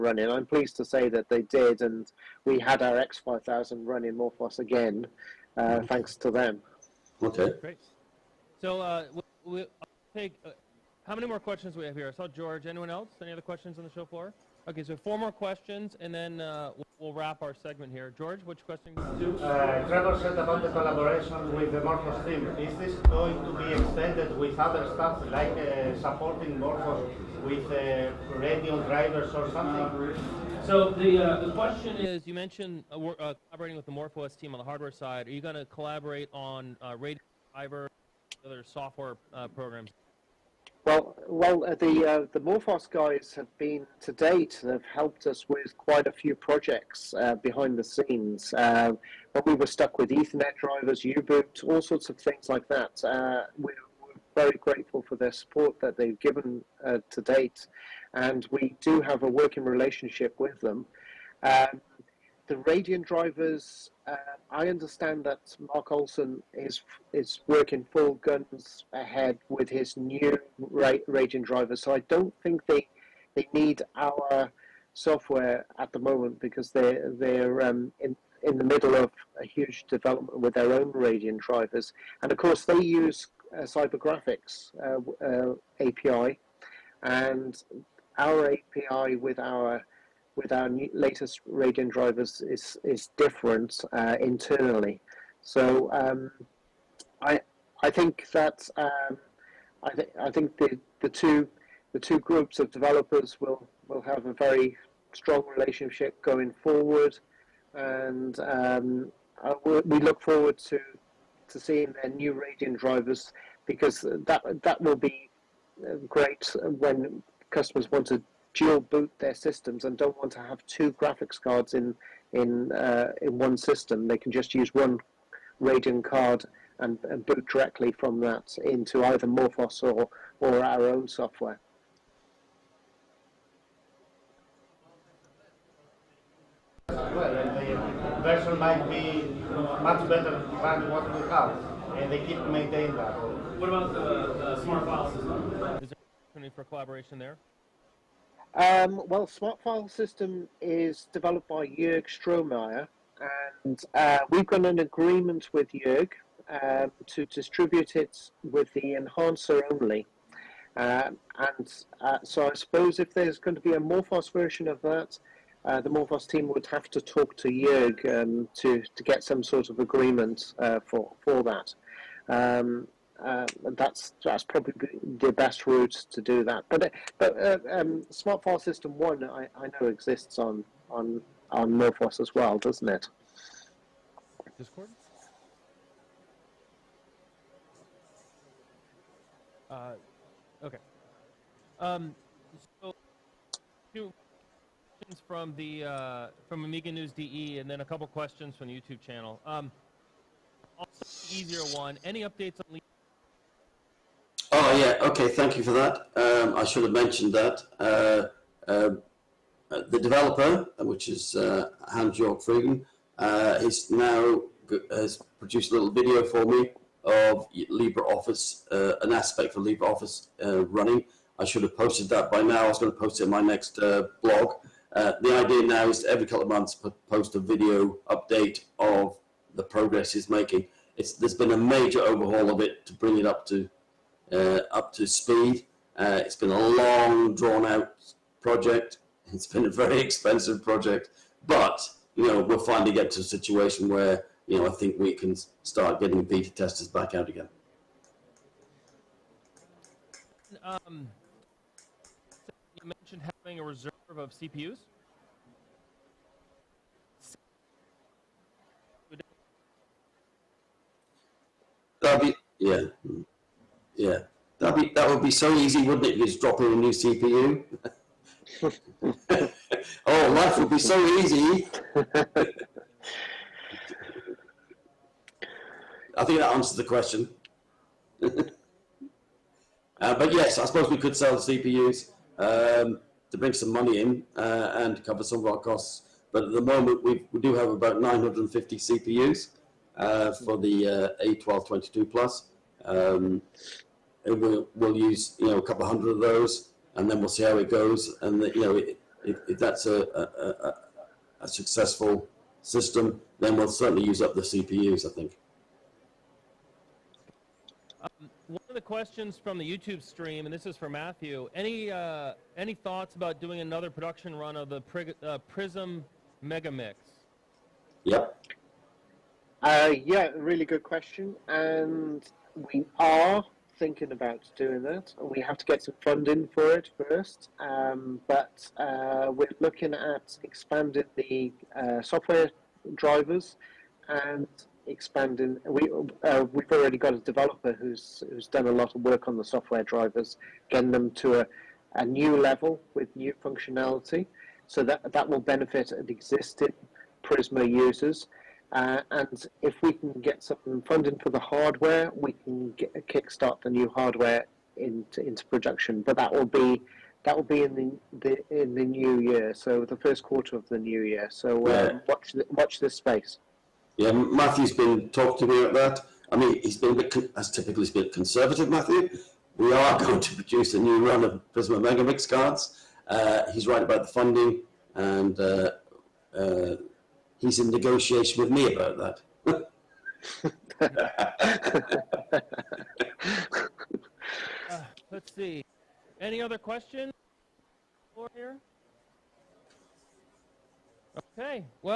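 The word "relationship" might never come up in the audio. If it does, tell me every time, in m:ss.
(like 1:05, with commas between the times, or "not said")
0:59, 1:45.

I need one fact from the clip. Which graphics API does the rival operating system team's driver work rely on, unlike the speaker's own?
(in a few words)
CyberGraphX.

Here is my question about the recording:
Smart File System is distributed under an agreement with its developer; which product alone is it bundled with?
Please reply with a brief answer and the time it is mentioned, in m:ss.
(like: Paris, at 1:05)
the Enhancer, at 2:38.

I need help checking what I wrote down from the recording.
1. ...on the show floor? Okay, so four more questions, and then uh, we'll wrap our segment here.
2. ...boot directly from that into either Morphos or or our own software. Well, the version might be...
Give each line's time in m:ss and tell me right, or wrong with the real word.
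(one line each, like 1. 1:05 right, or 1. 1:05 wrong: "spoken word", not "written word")
1. 0:13 right
2. 2:07 right.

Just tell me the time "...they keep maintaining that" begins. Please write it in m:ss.
2:22.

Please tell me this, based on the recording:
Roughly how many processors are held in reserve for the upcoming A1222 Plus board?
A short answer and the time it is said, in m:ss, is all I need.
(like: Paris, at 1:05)
950, at 4:48.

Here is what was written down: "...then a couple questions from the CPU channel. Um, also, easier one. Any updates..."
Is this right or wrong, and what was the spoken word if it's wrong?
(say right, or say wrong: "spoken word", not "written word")
wrong: "YouTube", not "CPU".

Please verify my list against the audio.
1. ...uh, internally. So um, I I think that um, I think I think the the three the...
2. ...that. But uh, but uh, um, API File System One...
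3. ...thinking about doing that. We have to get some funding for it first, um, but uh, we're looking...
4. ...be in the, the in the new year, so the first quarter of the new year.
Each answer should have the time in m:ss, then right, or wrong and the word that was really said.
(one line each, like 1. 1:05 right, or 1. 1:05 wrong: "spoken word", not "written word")
1. 1:33 wrong: "two", not "three"
2. 2:56 wrong: "Smart", not "API"
3. 5:23 right
4. 5:57 right.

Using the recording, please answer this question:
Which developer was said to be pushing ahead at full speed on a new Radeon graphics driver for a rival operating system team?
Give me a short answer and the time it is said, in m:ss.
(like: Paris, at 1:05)
Mark Olsen, at 1:05.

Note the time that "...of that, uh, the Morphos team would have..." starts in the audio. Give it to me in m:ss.
2:44.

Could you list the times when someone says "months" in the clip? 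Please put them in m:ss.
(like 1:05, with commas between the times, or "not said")
3:46.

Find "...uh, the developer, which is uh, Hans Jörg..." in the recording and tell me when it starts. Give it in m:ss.
3:28.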